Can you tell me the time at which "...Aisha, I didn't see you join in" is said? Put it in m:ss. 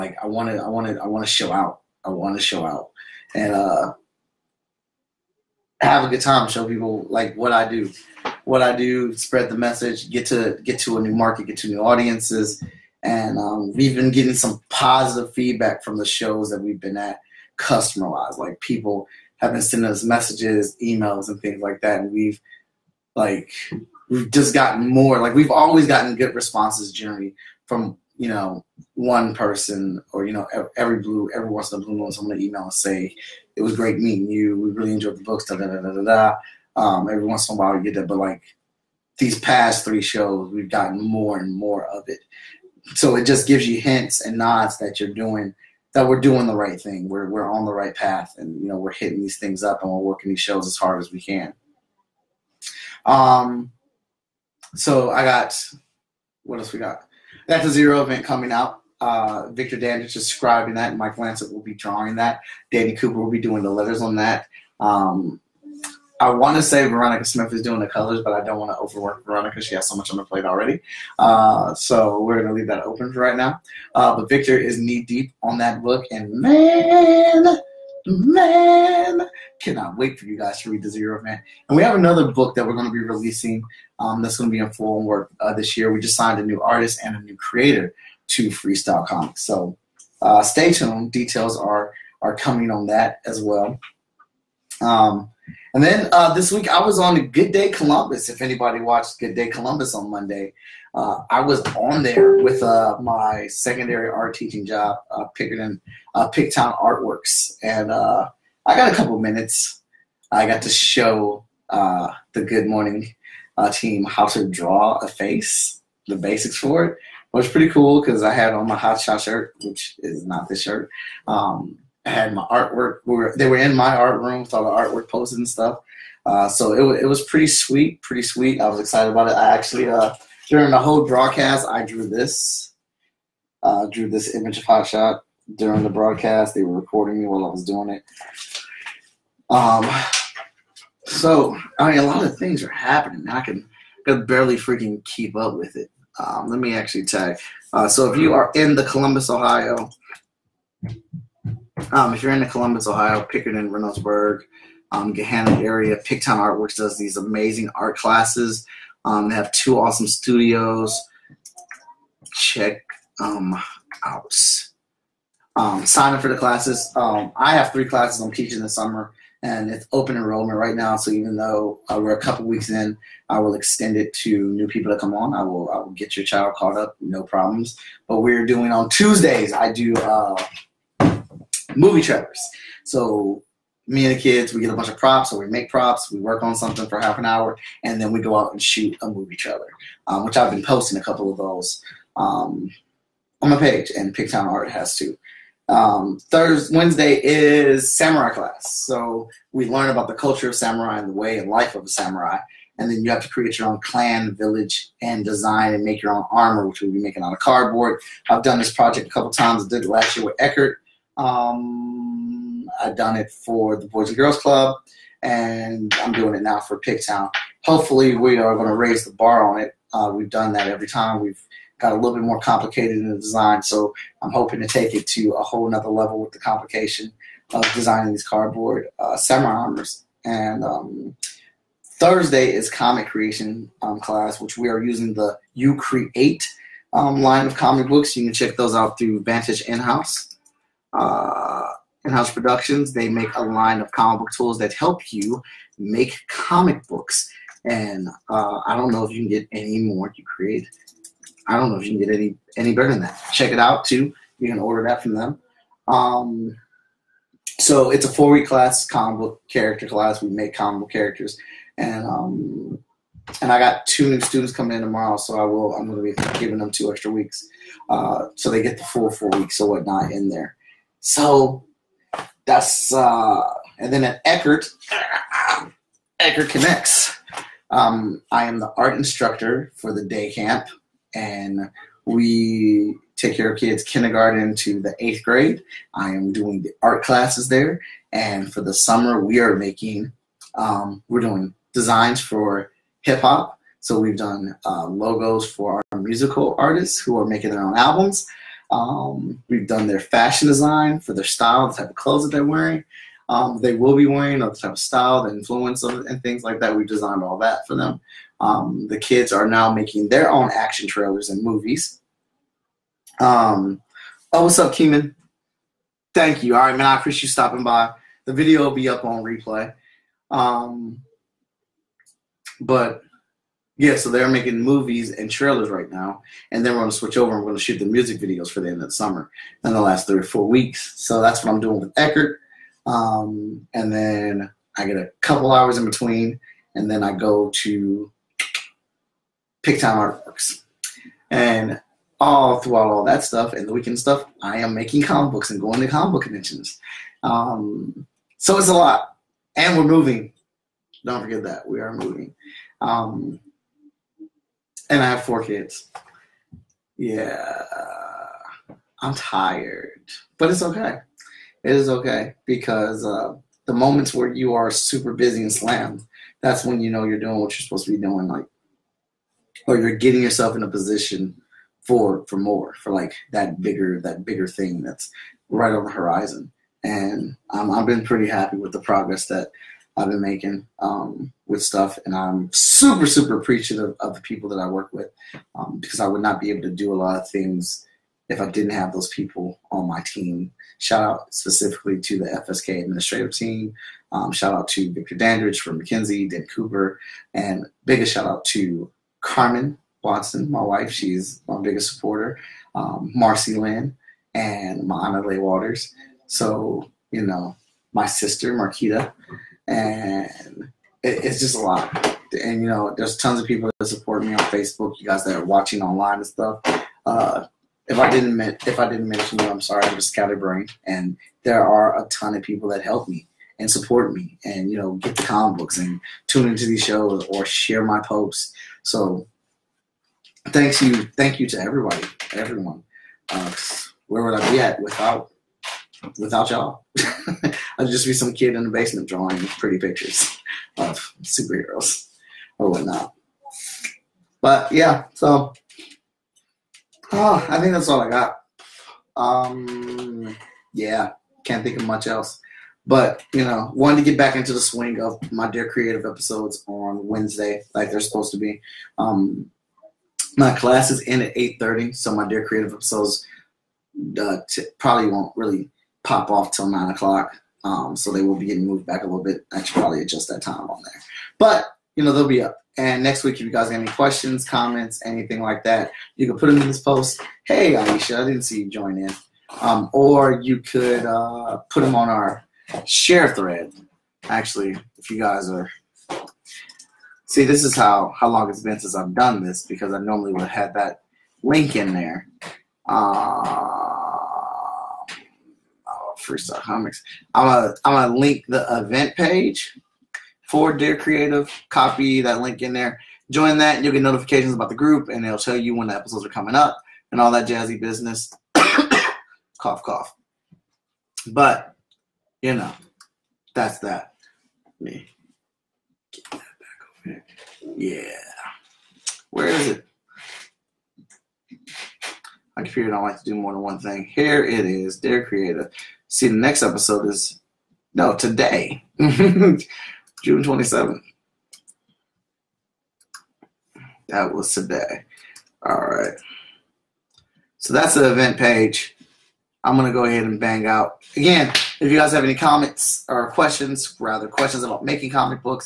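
7:57.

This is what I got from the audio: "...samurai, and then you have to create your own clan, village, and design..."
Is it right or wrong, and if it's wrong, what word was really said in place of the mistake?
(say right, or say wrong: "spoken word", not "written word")
right.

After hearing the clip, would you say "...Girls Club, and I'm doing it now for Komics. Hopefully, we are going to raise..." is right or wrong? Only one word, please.
wrong.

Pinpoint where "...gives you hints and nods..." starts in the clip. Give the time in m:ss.
0:43.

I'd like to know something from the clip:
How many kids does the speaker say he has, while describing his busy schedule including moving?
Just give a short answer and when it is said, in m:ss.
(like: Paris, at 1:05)
4, at 5:55.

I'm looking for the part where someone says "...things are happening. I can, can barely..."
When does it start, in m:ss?
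2:22.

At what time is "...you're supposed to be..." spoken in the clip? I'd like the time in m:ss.
6:07.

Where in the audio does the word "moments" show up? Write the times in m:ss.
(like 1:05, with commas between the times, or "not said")
6:03.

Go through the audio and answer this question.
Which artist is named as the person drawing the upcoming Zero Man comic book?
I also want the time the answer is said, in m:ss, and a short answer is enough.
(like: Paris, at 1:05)
Mike Lancet, at 1:00.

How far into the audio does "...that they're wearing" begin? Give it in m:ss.
5:02.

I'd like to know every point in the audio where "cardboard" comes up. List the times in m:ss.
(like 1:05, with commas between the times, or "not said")
3:27, 3:48.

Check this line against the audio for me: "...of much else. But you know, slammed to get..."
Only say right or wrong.
wrong.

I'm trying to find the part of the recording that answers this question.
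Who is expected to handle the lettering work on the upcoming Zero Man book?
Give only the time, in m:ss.
1:02.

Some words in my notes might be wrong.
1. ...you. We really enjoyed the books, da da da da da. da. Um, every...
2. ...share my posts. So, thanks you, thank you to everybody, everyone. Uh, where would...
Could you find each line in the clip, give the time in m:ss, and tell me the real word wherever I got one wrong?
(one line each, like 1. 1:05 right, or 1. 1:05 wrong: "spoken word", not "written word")
1. 0:34 right
2. 7:07 right.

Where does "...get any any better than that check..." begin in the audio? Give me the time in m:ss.
4:11.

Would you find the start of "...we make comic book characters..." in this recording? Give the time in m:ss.
4:20.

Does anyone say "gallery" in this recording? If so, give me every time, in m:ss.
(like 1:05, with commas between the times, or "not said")
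not said.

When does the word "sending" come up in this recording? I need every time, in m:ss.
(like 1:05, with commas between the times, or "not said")
0:19.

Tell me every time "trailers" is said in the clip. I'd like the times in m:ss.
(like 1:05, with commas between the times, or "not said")
3:02, 3:09, 5:10, 5:25.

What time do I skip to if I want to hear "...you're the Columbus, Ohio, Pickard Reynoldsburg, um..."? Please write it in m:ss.
2:32.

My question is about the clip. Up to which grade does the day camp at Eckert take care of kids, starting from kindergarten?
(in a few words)
eighth grade.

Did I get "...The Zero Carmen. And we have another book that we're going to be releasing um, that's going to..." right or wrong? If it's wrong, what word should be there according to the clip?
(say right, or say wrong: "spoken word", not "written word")
wrong: "Man", not "Carmen".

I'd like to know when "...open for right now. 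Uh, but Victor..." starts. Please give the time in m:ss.
1:12.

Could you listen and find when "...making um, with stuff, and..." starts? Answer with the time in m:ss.
6:20.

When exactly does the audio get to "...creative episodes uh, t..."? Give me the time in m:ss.
7:42.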